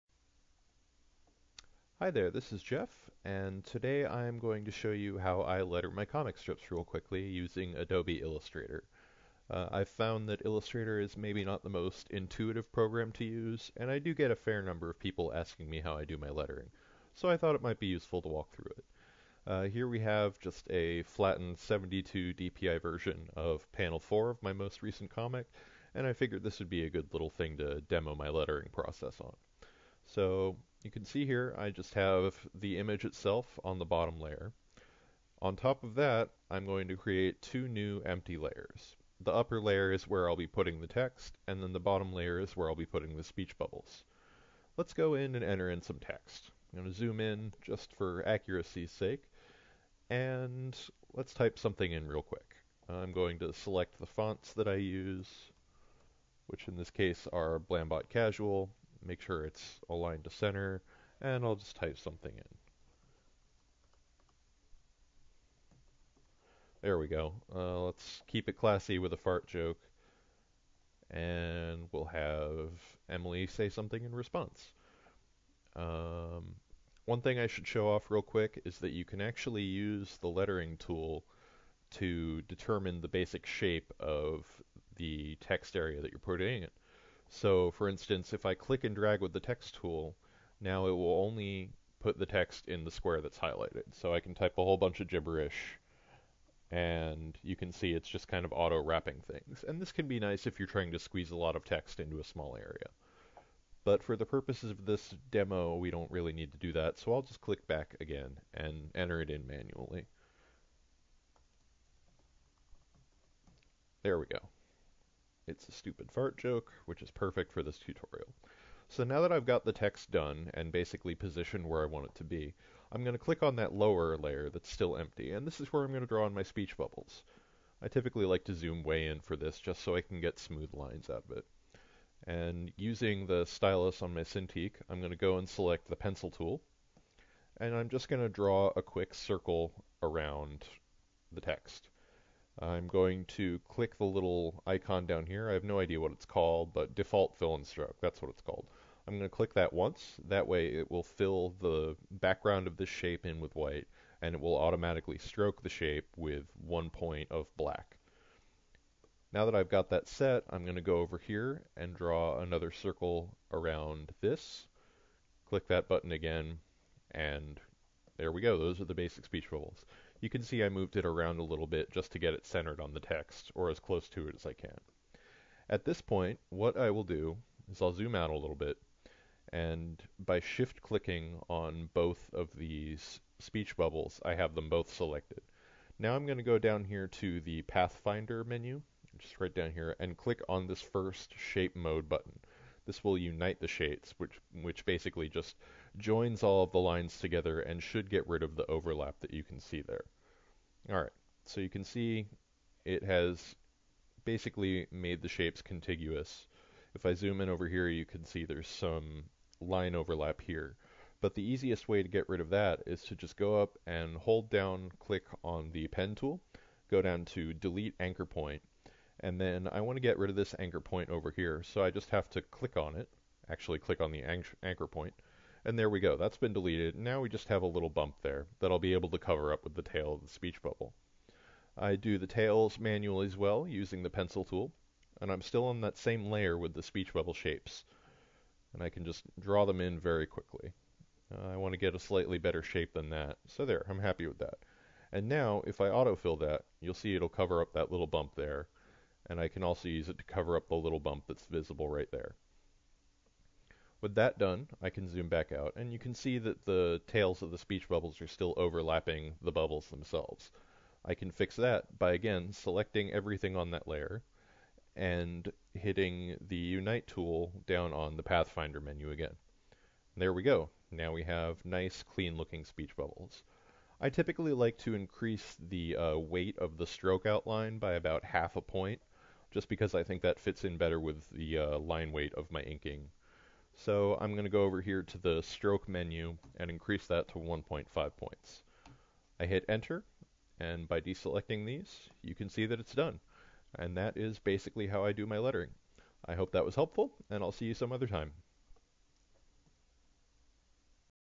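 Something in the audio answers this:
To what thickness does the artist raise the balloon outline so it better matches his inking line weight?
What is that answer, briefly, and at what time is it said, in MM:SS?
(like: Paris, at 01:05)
1.5 points, at 04:47.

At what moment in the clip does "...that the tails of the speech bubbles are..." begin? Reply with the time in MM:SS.
04:16.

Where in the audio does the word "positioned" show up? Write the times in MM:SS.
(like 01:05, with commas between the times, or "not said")
02:01.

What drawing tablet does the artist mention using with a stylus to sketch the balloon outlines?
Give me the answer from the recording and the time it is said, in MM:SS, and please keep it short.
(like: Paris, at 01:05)
Cintiq, at 02:14.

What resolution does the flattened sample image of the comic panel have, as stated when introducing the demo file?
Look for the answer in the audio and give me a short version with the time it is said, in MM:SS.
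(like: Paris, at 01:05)
72 dpi, at 00:21.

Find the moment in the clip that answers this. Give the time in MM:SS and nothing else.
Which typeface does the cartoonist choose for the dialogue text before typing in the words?
00:57.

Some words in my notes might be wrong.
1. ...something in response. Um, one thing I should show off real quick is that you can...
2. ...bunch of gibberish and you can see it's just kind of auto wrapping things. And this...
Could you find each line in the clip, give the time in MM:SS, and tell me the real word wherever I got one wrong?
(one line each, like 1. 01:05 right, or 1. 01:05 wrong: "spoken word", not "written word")
1. 01:13 right
2. 01:34 right.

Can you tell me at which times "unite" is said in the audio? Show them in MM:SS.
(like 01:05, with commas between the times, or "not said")
03:13, 04:26.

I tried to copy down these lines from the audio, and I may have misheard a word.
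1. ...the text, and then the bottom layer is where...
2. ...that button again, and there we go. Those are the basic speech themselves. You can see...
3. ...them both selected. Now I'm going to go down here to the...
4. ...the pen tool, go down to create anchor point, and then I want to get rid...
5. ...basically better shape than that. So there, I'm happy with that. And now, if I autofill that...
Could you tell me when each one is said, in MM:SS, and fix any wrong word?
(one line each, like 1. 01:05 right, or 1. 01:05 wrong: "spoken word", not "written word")
1. 00:40 right
2. 02:45 wrong: "bubbles", not "themselves"
3. 03:04 right
4. 03:35 wrong: "delete", not "create"
5. 04:01 wrong: "slightly", not "basically".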